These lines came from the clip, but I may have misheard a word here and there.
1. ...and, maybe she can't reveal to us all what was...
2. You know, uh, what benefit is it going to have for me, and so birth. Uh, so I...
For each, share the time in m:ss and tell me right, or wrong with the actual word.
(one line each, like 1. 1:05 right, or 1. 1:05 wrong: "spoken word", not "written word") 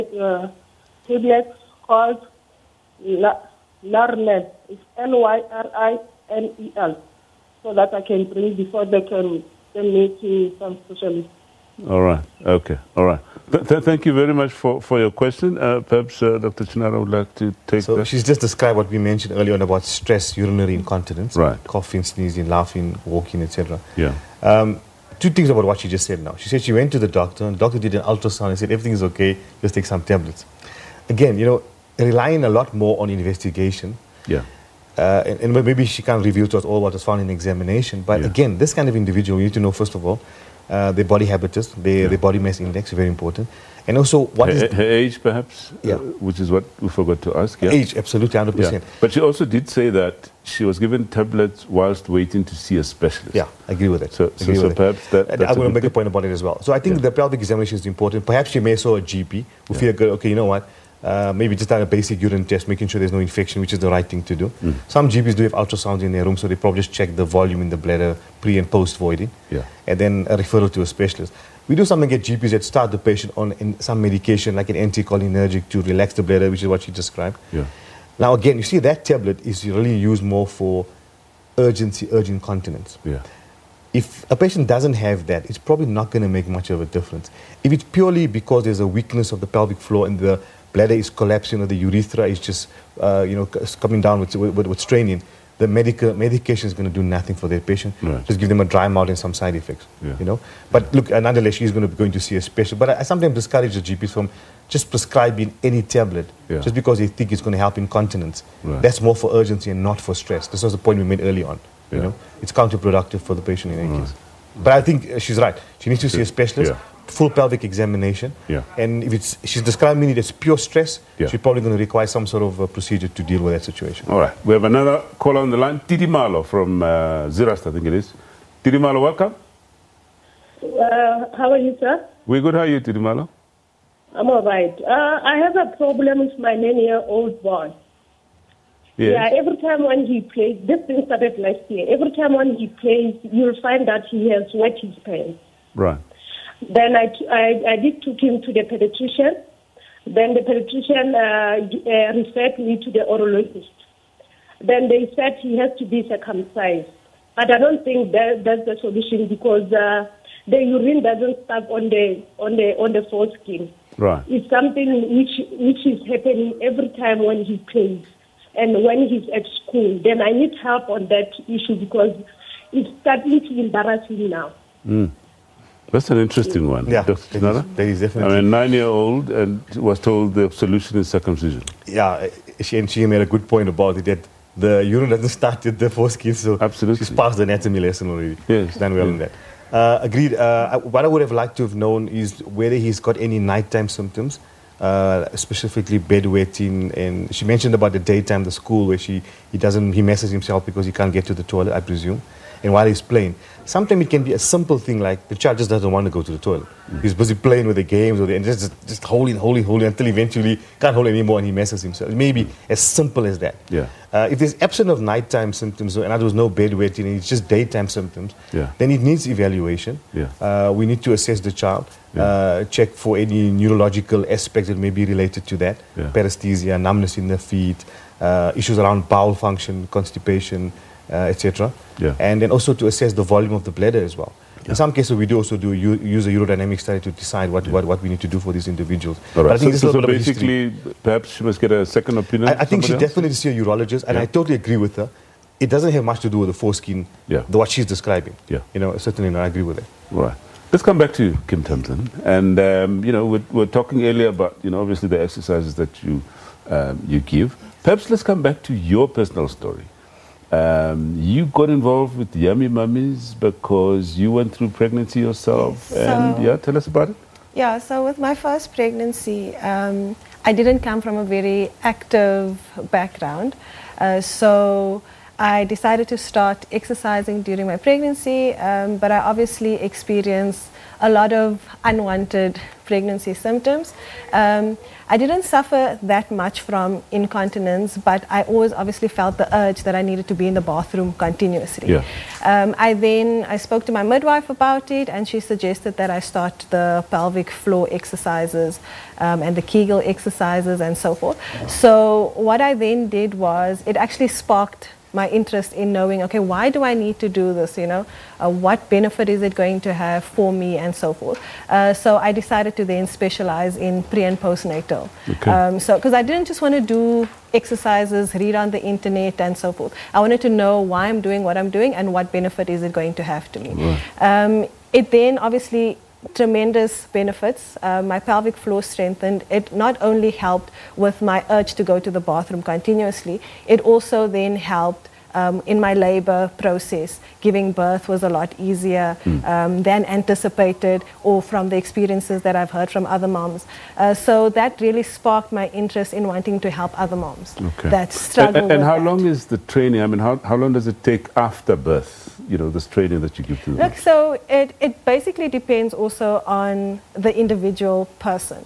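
1. 0:35 right
2. 5:07 wrong: "forth", not "birth".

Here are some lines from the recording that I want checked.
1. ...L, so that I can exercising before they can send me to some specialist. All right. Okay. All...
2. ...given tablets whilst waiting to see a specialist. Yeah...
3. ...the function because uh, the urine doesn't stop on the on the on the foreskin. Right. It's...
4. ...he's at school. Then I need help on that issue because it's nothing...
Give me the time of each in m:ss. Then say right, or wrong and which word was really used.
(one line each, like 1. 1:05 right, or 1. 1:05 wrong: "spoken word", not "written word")
1. 0:06 wrong: "bring", not "exercising"
2. 0:50 right
3. 2:38 wrong: "solution", not "function"
4. 2:49 wrong: "starting", not "nothing".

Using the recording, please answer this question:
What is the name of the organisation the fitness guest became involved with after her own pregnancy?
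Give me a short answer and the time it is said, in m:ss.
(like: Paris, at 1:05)
Yummy Mummies, at 4:22.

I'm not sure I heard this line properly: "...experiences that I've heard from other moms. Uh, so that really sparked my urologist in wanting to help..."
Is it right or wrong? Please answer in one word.
wrong.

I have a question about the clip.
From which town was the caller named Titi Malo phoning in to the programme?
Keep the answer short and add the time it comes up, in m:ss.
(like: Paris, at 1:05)
Zeerust, at 2:07.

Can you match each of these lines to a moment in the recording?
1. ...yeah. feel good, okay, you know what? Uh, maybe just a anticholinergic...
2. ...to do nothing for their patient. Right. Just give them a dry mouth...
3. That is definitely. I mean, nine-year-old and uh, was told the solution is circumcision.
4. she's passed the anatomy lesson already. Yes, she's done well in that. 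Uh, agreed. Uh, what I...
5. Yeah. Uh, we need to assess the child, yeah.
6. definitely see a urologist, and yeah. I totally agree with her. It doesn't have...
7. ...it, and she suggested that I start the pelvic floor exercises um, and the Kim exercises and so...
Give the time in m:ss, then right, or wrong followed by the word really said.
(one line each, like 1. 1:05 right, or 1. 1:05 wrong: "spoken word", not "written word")
1. 0:59 wrong: "basic", not "anticholinergic"
2. 1:36 right
3. 2:57 right
4. 3:07 right
5. 3:40 right
6. 4:03 right
7. 4:54 wrong: "Kegel", not "Kim".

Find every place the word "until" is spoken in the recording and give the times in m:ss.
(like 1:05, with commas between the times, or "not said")
3:29.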